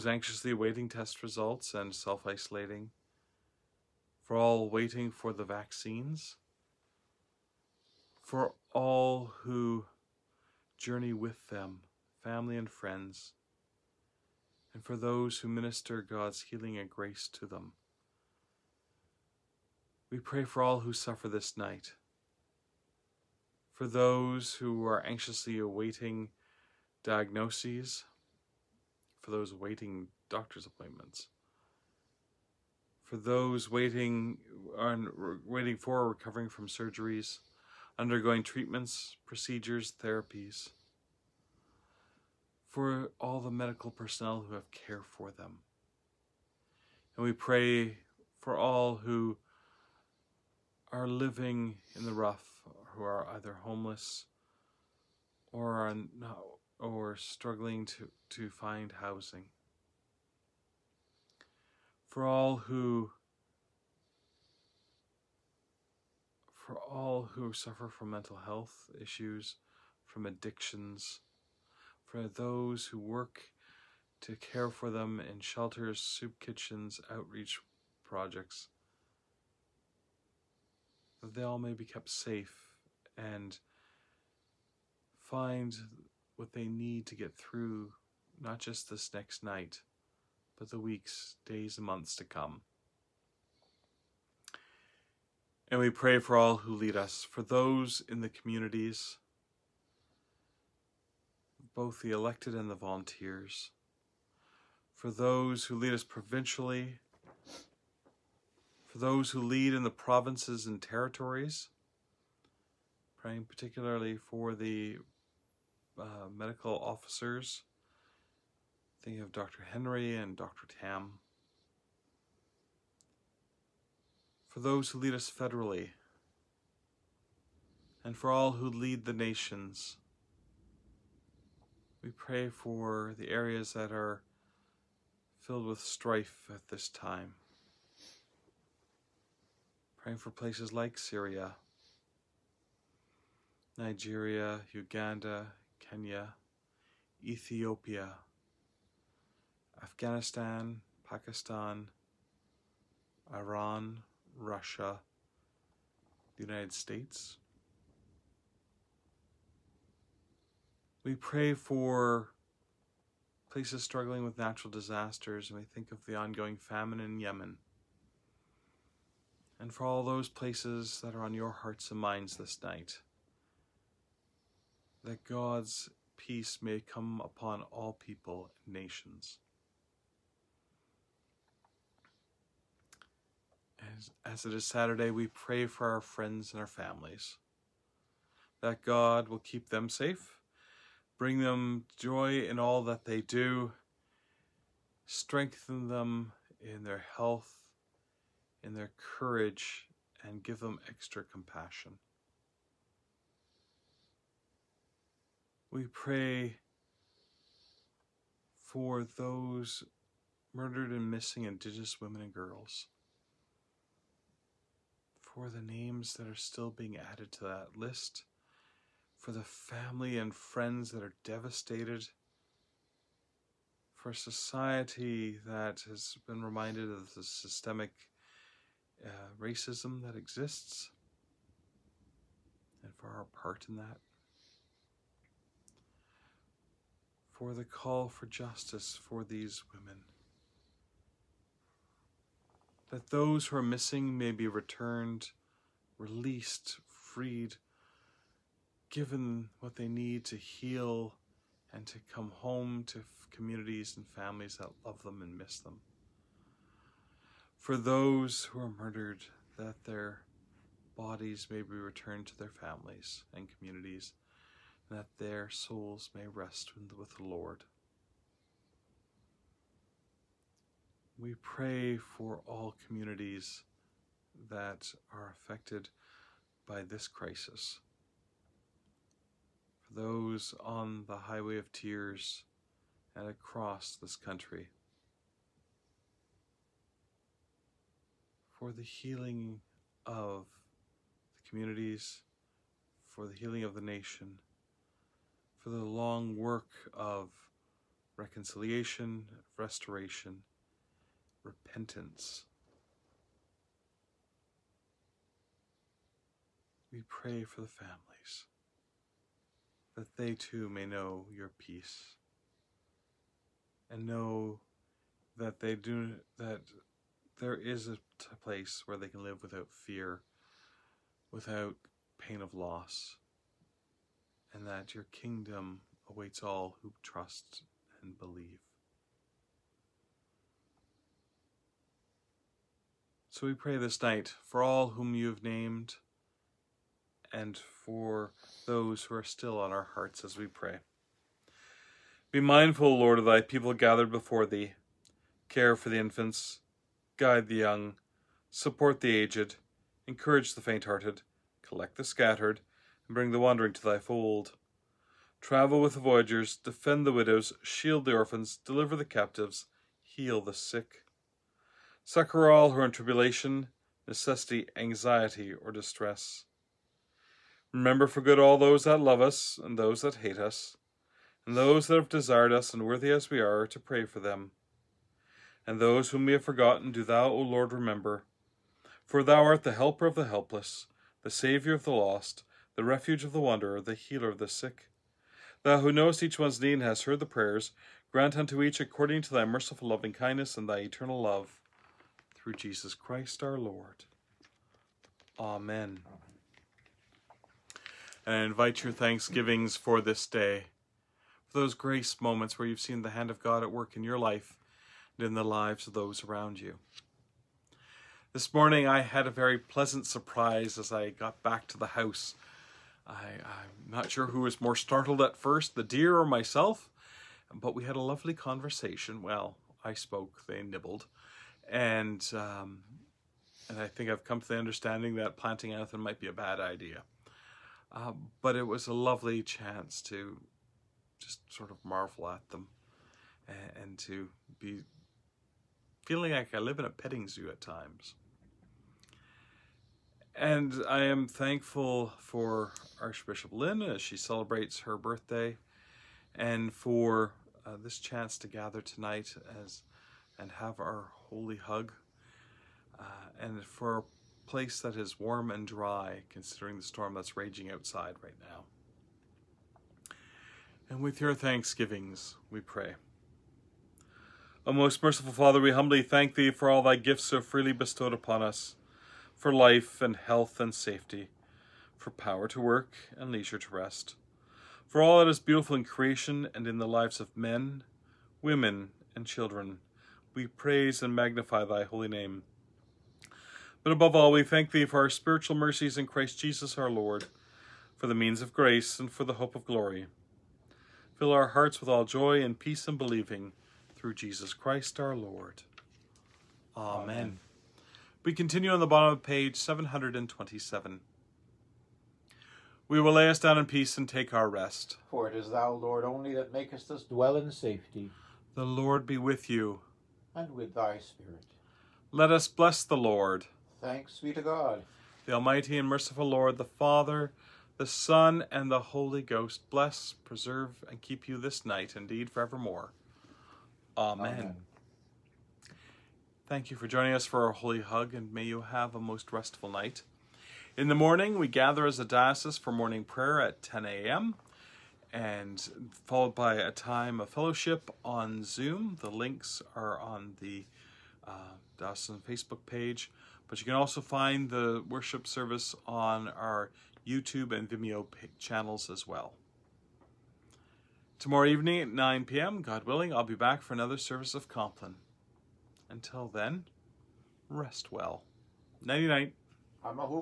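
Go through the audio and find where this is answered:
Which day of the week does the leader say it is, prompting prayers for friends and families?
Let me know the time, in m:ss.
3:04.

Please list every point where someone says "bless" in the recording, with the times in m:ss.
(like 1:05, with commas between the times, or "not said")
8:32, 8:39.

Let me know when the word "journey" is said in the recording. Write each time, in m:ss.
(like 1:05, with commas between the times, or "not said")
0:10.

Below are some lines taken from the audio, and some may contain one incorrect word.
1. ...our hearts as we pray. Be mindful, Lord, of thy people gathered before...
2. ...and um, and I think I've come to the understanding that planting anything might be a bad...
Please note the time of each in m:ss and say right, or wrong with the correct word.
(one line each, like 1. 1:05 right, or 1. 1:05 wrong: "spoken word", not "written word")
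1. 5:39 right
2. 7:01 right.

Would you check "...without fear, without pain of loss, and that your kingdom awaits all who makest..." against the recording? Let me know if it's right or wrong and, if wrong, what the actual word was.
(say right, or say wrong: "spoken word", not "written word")
wrong: "trust", not "makest".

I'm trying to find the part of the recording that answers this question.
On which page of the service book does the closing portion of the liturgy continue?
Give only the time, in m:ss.
8:19.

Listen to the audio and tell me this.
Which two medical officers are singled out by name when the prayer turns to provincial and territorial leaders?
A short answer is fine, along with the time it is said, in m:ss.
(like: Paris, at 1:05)
Dr. Henry and Dr. Tam, at 1:59.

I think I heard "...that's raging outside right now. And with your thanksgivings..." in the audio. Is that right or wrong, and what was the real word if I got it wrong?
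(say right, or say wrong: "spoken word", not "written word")
right.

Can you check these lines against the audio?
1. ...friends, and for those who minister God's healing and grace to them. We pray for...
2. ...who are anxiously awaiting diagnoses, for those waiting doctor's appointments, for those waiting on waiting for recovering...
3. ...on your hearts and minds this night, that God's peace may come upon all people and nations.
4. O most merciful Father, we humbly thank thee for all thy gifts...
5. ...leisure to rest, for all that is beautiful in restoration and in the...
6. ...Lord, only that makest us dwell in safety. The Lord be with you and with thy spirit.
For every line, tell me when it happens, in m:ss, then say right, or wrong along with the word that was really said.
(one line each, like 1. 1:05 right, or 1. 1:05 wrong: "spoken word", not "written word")
1. 0:12 right
2. 0:24 right
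3. 2:51 right
4. 7:44 right
5. 7:53 wrong: "creation", not "restoration"
6. 8:25 right.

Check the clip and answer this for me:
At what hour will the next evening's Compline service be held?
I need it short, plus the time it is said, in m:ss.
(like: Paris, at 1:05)
9 p.m., at 9:11.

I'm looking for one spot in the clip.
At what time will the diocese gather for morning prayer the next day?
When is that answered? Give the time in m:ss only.
8:53.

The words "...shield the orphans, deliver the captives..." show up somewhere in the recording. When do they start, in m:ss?
5:57.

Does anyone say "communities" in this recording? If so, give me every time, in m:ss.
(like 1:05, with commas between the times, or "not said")
1:38, 4:13, 4:23, 4:32, 4:51.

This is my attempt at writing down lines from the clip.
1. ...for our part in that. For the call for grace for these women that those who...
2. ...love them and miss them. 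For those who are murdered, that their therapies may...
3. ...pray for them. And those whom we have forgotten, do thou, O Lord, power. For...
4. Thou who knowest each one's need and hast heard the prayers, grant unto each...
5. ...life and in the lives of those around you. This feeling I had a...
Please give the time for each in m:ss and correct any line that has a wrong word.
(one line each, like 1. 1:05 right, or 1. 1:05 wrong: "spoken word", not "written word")
1. 3:52 wrong: "justice", not "grace"
2. 4:14 wrong: "bodies", not "therapies"
3. 6:13 wrong: "remember", not "power"
4. 6:25 right
5. 6:44 wrong: "morning", not "feeling".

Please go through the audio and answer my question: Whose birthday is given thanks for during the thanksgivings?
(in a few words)
Archbishop Lynn.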